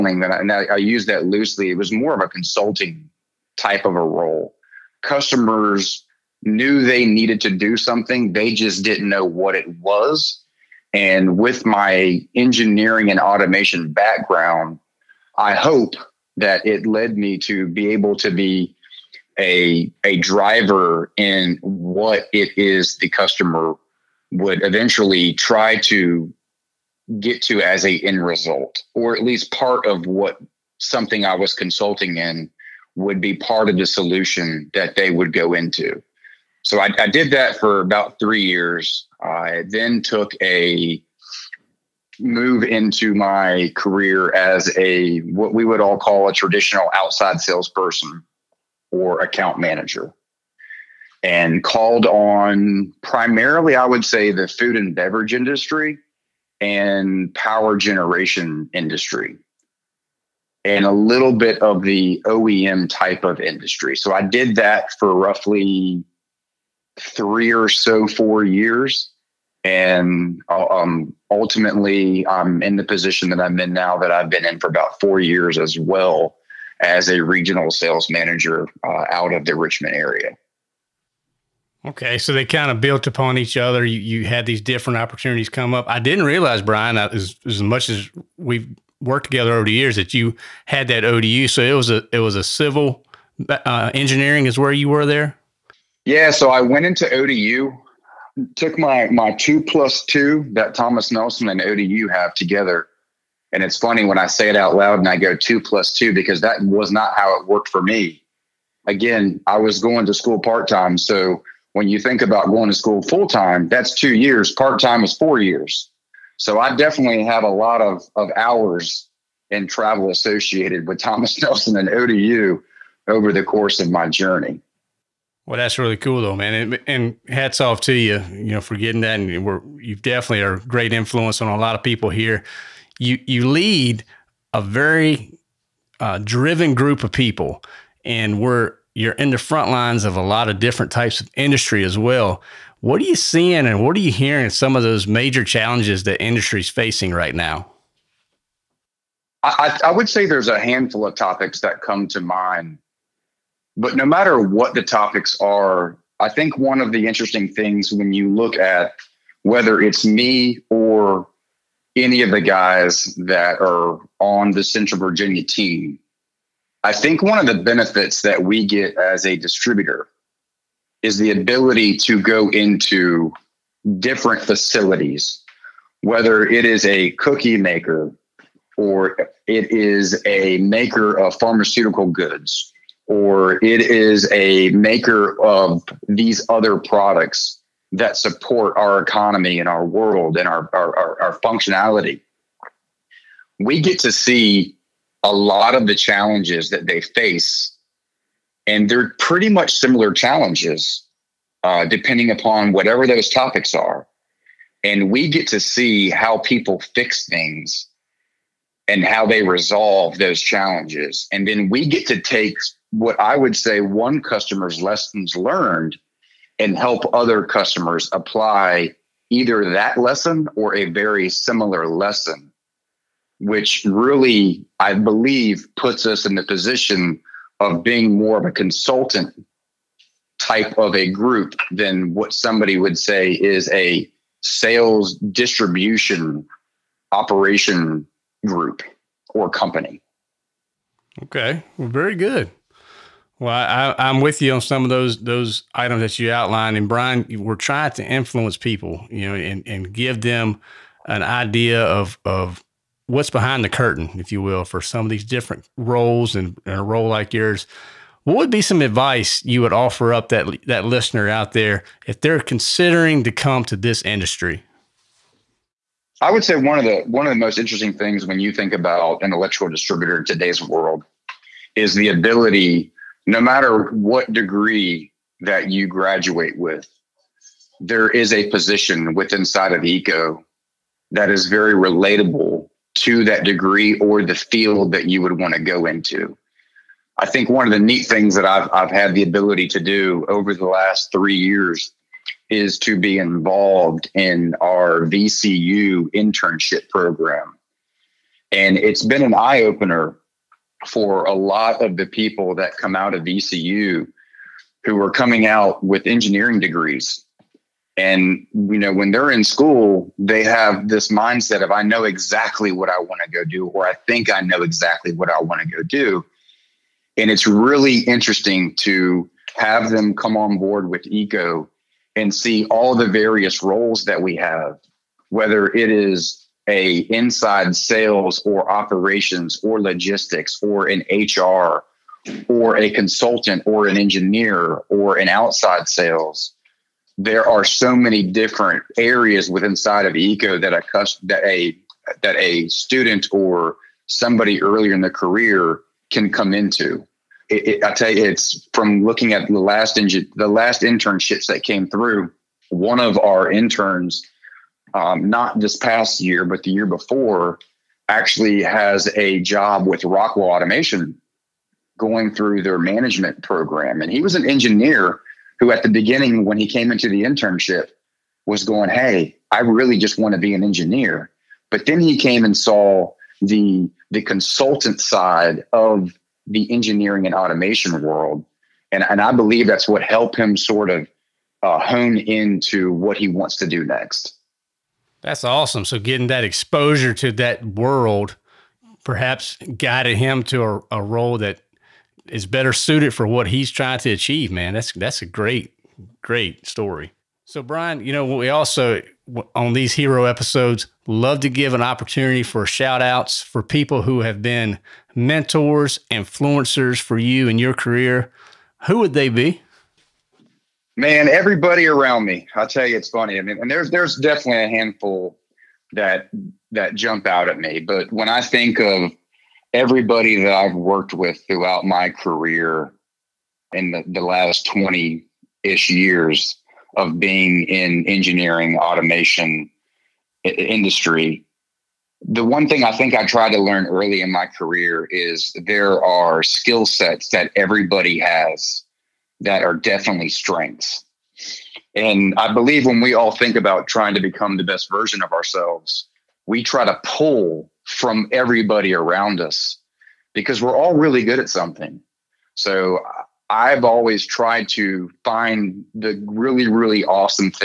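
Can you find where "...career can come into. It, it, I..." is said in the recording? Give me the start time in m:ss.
5:45.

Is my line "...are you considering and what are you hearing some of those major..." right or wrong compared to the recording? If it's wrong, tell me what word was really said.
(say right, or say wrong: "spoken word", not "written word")
wrong: "seeing", not "considering".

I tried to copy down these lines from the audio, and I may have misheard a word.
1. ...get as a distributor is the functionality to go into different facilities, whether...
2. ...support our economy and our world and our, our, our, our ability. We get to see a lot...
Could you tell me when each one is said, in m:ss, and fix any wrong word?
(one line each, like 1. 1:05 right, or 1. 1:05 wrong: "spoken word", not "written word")
1. 2:48 wrong: "ability", not "functionality"
2. 3:08 wrong: "functionality", not "ability".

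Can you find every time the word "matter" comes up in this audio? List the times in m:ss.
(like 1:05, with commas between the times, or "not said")
2:34, 4:33.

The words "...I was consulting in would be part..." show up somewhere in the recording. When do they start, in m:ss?
0:31.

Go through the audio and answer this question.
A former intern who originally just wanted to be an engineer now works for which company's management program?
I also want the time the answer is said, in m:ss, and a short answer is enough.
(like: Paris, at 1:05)
Rockwell Automation, at 6:00.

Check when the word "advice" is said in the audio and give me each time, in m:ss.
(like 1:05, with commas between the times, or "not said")
4:18.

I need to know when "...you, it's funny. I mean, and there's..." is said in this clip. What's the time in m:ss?
6:52.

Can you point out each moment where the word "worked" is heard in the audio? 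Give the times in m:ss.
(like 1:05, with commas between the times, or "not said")
1:28, 1:47, 7:00.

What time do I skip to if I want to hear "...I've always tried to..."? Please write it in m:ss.
7:33.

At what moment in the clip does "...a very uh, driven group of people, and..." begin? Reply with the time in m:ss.
2:14.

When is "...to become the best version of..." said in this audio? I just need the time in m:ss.
7:24.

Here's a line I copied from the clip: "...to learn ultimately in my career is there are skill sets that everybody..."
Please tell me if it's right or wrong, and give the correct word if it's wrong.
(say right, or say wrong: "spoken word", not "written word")
wrong: "early", not "ultimately".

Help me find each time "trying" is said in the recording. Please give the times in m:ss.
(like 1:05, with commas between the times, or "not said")
4:07, 6:33, 7:23.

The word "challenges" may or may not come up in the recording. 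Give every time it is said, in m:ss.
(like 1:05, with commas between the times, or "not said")
2:25, 3:15, 3:20, 3:30.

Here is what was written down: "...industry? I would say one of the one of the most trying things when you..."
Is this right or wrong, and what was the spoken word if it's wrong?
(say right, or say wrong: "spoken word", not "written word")
wrong: "interesting", not "trying".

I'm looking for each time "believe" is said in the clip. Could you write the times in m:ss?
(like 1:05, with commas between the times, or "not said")
3:44, 6:19, 7:22.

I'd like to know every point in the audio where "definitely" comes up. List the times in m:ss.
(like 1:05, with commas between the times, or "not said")
1:56, 2:09, 6:54, 7:19.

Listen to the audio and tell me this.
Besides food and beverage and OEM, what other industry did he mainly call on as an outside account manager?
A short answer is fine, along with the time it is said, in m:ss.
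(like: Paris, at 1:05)
Power generation, at 0:57.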